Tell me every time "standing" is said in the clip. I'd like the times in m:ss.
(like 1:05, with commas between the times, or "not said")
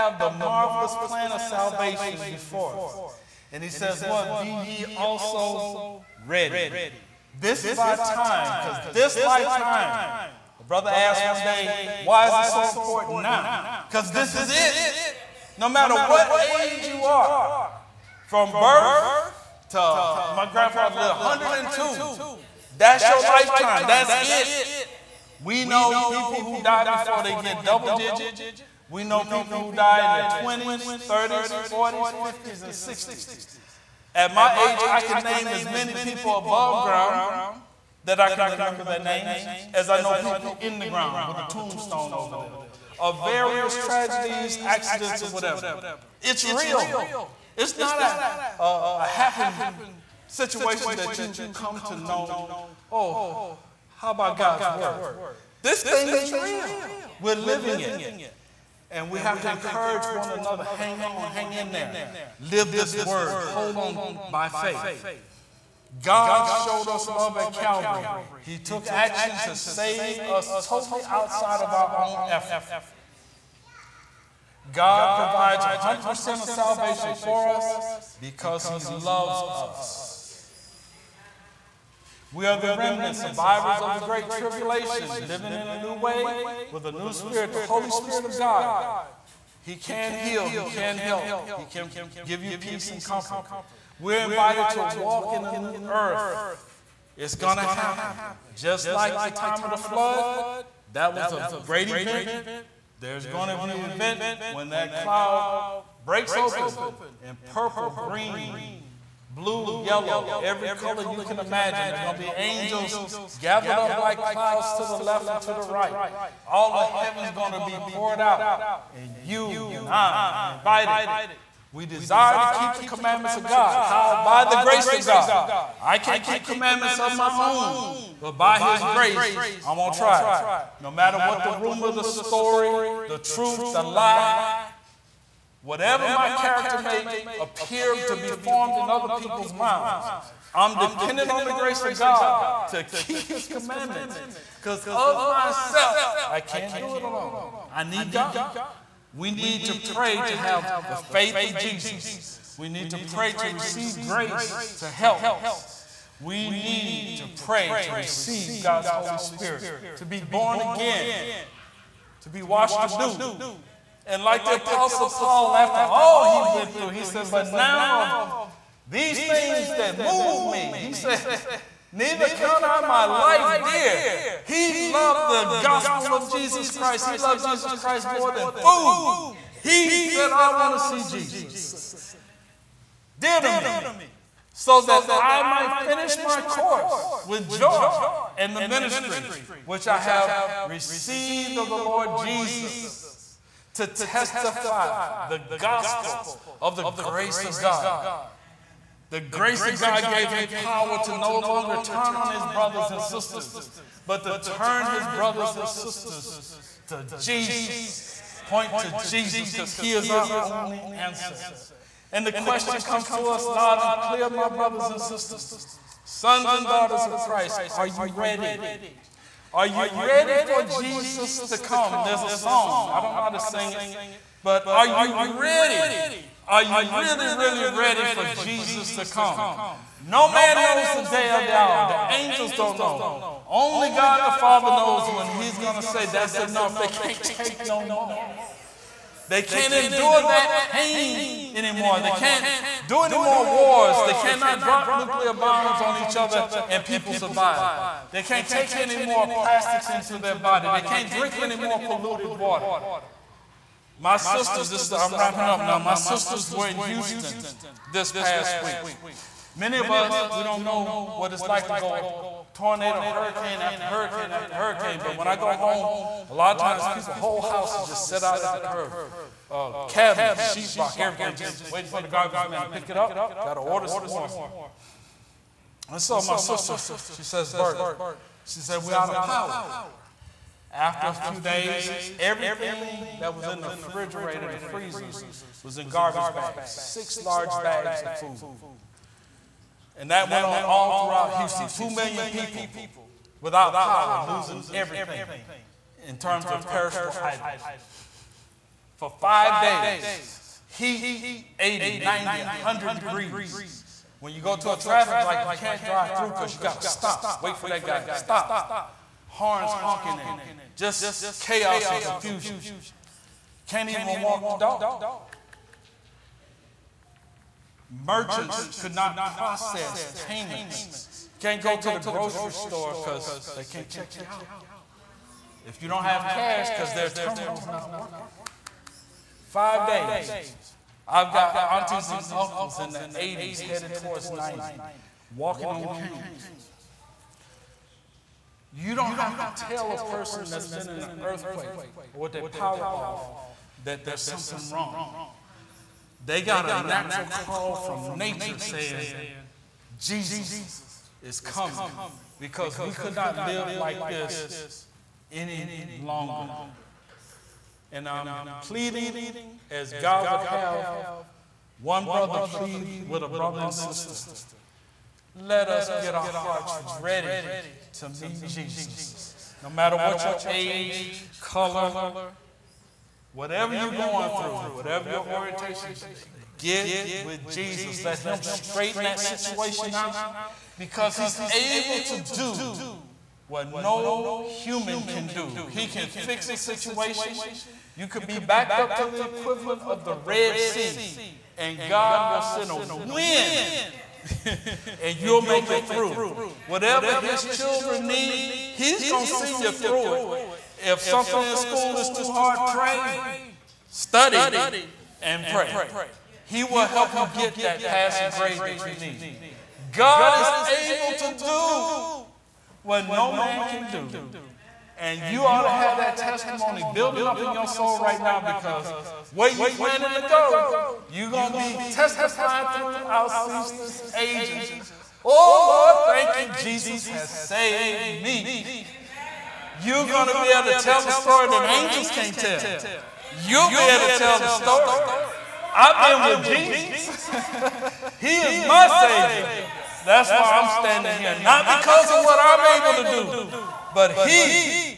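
7:20.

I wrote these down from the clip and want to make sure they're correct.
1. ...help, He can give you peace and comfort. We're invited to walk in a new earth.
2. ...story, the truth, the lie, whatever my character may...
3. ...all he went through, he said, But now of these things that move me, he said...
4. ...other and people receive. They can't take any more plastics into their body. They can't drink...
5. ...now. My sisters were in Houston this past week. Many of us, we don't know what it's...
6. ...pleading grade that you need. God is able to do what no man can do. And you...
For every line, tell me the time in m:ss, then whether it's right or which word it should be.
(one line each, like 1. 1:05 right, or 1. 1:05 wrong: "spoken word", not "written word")
1. 1:30 right
2. 2:12 right
3. 2:45 right
4. 4:06 wrong: "survive", not "receive"
5. 4:15 right
6. 6:47 wrong: "passing", not "pleading".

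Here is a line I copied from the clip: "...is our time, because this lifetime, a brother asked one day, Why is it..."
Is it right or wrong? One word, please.
right.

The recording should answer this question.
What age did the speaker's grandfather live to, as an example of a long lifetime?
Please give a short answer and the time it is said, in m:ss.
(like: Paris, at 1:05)
102, at 0:21.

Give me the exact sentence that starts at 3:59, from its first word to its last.
They can't endure that pain anymore.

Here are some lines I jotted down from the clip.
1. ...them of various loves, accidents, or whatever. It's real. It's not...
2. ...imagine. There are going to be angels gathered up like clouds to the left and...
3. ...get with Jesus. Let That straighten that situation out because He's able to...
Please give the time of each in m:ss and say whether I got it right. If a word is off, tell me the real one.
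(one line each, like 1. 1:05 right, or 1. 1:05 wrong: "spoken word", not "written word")
1. 0:42 wrong: "tragedies", not "loves"
2. 1:51 right
3. 6:16 wrong: "Him", not "That".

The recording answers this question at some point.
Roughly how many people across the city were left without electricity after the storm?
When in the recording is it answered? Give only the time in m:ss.
4:51.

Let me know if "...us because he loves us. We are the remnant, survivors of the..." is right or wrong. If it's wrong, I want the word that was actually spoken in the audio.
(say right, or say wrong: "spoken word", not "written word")
right.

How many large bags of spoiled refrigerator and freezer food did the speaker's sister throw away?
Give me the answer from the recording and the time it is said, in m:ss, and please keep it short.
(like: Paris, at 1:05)
6, at 4:46.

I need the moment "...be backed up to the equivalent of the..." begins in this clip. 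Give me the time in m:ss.
6:28.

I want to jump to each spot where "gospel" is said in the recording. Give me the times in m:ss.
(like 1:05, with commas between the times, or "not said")
2:55, 3:15.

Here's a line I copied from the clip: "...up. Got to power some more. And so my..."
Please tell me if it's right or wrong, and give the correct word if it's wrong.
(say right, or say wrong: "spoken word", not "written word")
wrong: "order", not "power".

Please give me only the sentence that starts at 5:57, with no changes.
And I'm pleading as God would have one brother plead with a brother and sister.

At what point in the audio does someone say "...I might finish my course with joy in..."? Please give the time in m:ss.
3:05.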